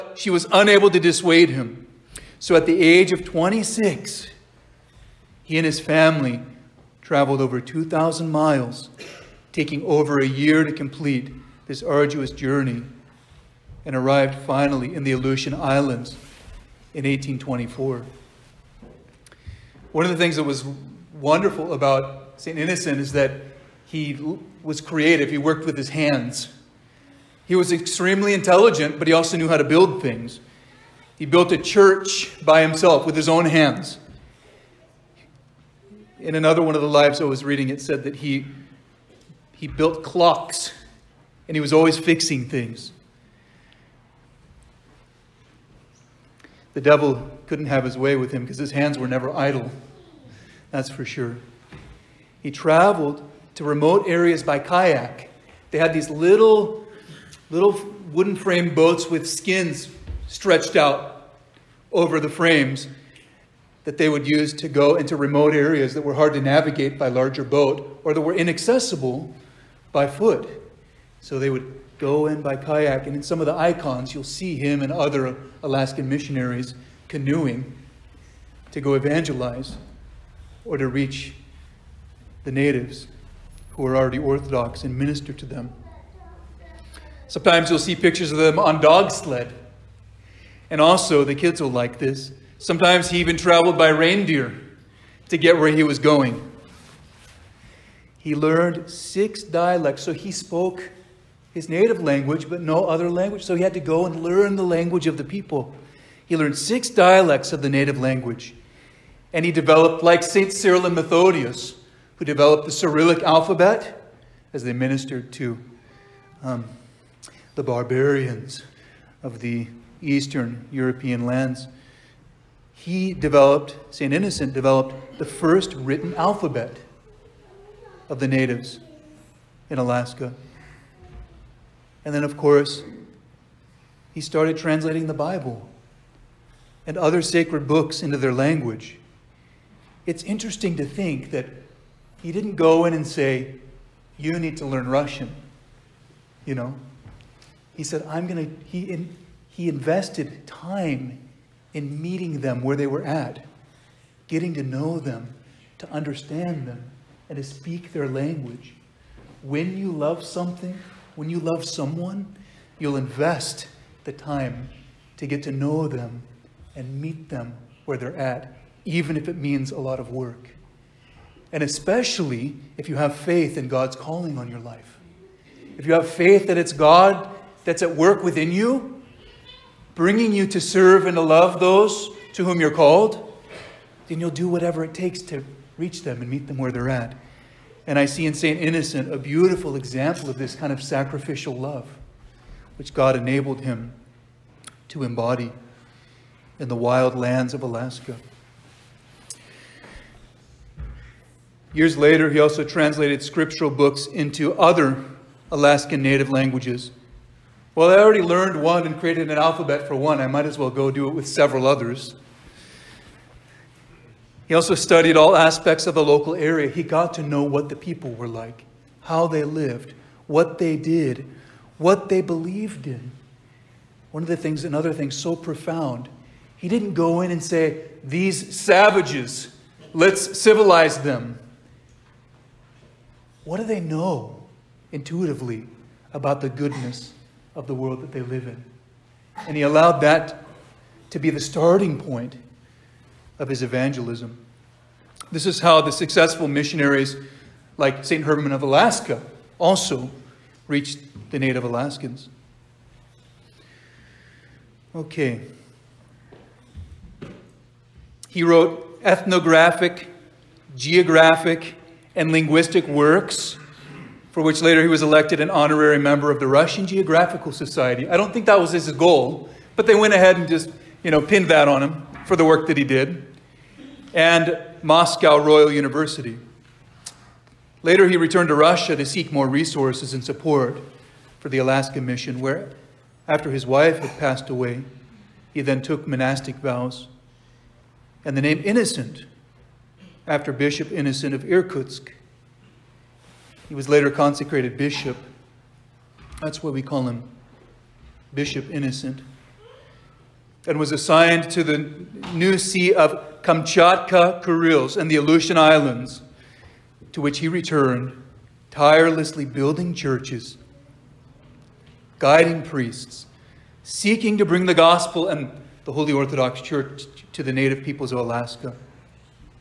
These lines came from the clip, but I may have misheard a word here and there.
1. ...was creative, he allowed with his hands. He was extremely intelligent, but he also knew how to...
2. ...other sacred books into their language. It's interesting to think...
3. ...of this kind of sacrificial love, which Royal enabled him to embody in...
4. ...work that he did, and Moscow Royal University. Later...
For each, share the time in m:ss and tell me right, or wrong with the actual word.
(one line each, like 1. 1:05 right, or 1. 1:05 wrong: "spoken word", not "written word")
1. 0:24 wrong: "worked", not "allowed"
2. 2:16 right
3. 3:10 wrong: "God", not "Royal"
4. 4:32 right.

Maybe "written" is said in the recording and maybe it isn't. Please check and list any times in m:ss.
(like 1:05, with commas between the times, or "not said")
2:05.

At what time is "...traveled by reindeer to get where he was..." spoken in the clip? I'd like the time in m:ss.
1:33.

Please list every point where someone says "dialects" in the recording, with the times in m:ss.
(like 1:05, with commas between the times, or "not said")
1:39, 1:46.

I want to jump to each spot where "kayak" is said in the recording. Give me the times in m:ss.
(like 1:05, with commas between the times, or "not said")
0:54, 1:12.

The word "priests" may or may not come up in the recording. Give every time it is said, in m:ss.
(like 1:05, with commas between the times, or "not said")
5:12.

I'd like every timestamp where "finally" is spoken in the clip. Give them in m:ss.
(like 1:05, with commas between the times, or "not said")
0:14.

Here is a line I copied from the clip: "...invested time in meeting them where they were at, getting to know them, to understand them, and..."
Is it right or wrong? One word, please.
right.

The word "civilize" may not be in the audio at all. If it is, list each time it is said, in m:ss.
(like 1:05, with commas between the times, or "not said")
3:50.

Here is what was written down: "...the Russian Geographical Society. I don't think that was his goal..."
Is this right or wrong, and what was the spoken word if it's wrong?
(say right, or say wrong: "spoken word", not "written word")
right.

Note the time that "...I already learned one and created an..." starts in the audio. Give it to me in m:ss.
3:27.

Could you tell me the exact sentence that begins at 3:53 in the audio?
What do they know intuitively about the goodness of the world that they live in?